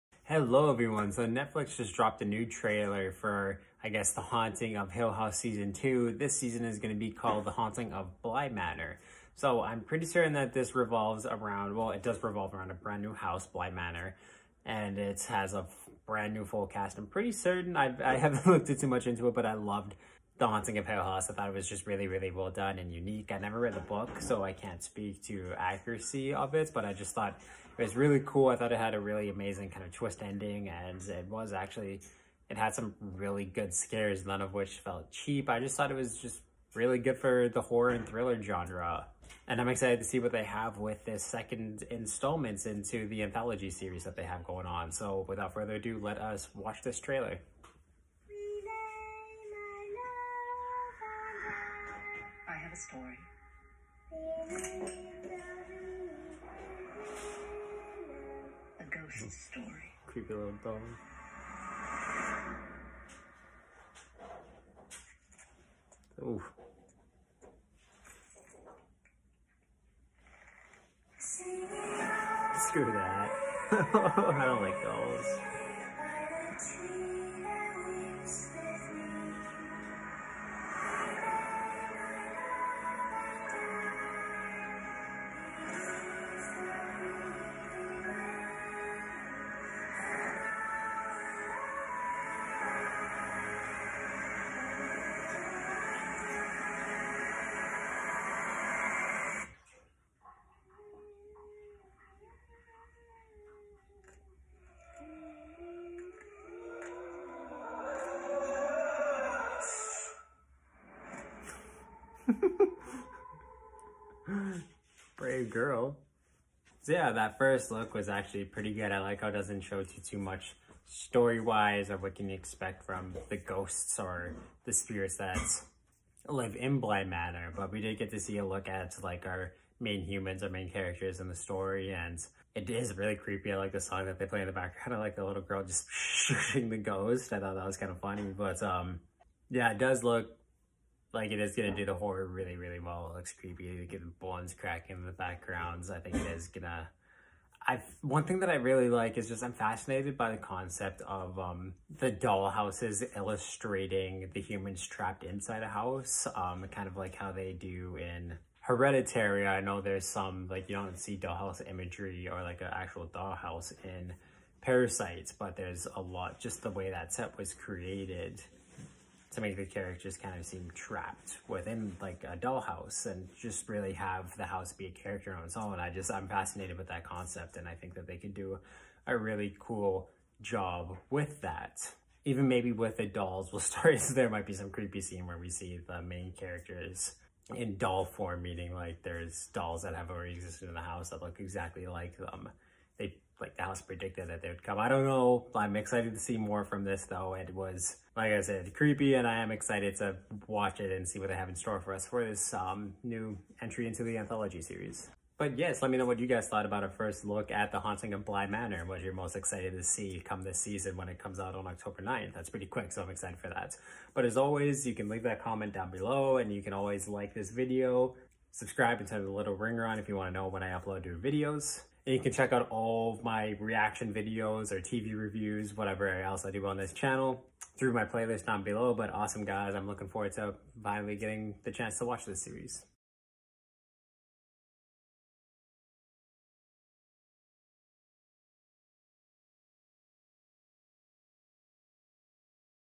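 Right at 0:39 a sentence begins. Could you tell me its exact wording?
And I'm excited to see what they have with this second installments into the anthology series that they have going on.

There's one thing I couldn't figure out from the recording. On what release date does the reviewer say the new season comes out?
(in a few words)
October 9.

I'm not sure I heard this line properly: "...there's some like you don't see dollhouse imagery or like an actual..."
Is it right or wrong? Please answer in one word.
right.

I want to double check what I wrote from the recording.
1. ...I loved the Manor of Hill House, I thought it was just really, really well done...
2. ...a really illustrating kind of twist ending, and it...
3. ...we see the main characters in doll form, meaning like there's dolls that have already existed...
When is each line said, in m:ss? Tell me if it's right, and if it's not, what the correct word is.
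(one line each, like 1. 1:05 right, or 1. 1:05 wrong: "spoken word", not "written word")
1. 0:19 wrong: "Haunting", not "Manor"
2. 0:28 wrong: "amazing", not "illustrating"
3. 3:05 right.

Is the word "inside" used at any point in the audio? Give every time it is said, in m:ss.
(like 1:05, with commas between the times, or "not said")
2:35.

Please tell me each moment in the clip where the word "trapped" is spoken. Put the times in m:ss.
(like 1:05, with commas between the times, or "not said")
2:34, 2:50.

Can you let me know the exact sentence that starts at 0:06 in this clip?
This season is going to be called The Haunting of Bly Manor.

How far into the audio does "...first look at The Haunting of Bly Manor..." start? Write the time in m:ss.
3:26.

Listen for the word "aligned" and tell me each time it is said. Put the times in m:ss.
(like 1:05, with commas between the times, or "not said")
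not said.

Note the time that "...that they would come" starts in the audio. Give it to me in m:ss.
3:14.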